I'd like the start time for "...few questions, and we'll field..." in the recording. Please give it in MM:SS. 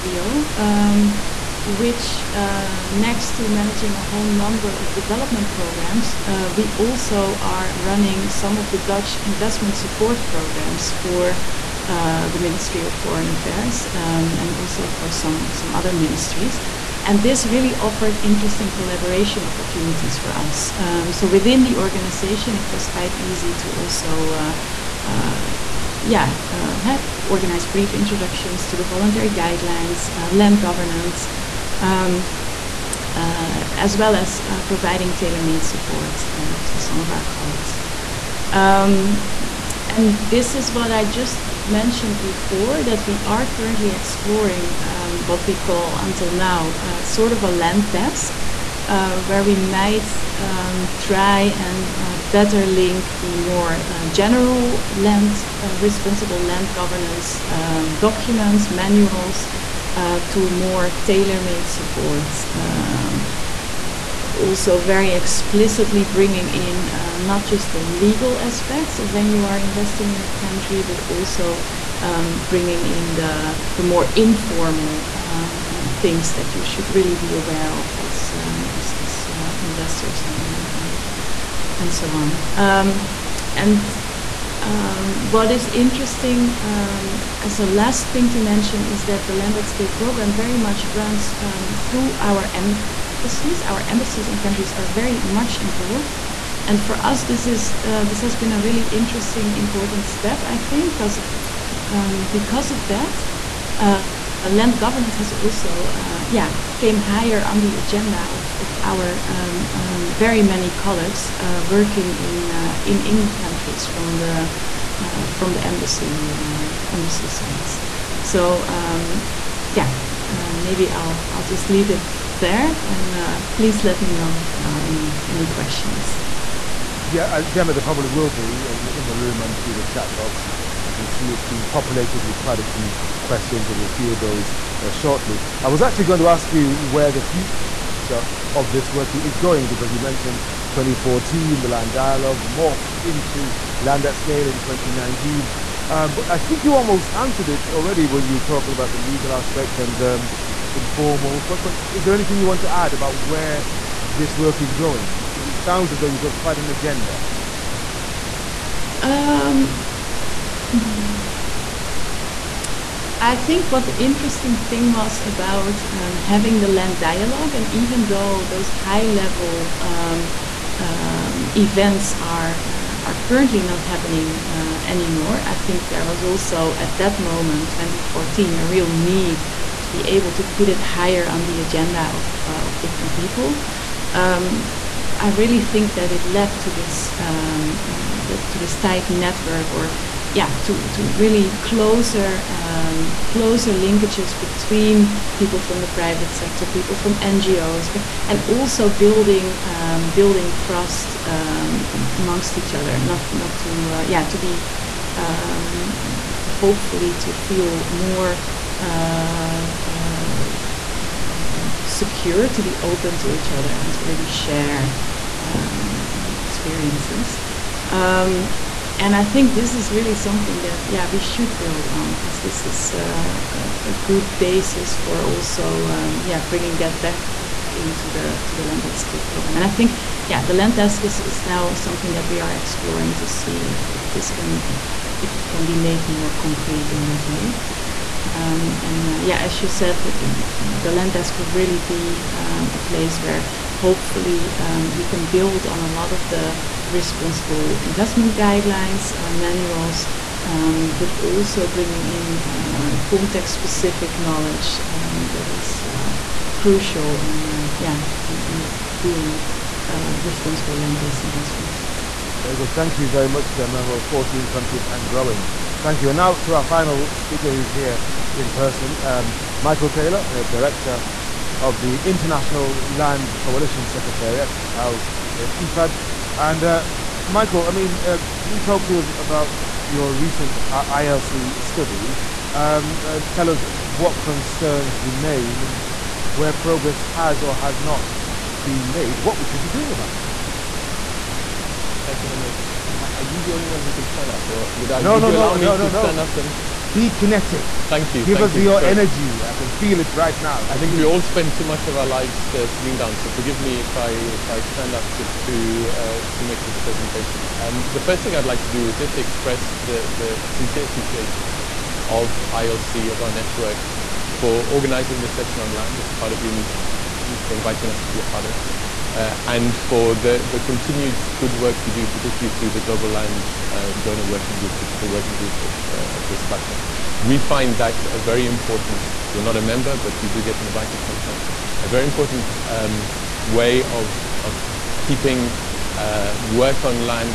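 02:12.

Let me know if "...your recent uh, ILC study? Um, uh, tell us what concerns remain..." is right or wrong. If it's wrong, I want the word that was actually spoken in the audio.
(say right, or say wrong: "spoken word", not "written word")
right.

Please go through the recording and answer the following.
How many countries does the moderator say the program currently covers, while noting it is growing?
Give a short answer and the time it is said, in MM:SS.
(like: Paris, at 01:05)
14, at 04:24.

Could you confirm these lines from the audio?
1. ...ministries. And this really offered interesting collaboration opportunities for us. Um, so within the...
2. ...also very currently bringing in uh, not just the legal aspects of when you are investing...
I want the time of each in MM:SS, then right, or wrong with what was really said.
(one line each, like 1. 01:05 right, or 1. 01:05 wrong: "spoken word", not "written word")
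1. 00:15 right
2. 01:04 wrong: "explicitly", not "currently".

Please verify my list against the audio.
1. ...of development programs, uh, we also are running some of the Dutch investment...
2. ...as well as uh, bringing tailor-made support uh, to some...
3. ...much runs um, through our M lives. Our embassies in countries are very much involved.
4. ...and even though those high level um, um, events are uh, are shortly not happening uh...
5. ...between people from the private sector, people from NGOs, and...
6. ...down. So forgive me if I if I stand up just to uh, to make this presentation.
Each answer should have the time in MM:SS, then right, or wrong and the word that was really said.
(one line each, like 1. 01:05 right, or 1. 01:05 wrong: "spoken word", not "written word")
1. 00:04 right
2. 00:33 wrong: "providing", not "bringing"
3. 01:30 wrong: "embassies", not "lives"
4. 02:47 wrong: "currently", not "shortly"
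5. 03:14 right
6. 05:02 right.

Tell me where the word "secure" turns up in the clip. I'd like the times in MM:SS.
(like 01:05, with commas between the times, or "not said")
03:31.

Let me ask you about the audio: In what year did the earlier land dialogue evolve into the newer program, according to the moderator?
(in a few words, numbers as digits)
2019.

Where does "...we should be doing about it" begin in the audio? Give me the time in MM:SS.
04:49.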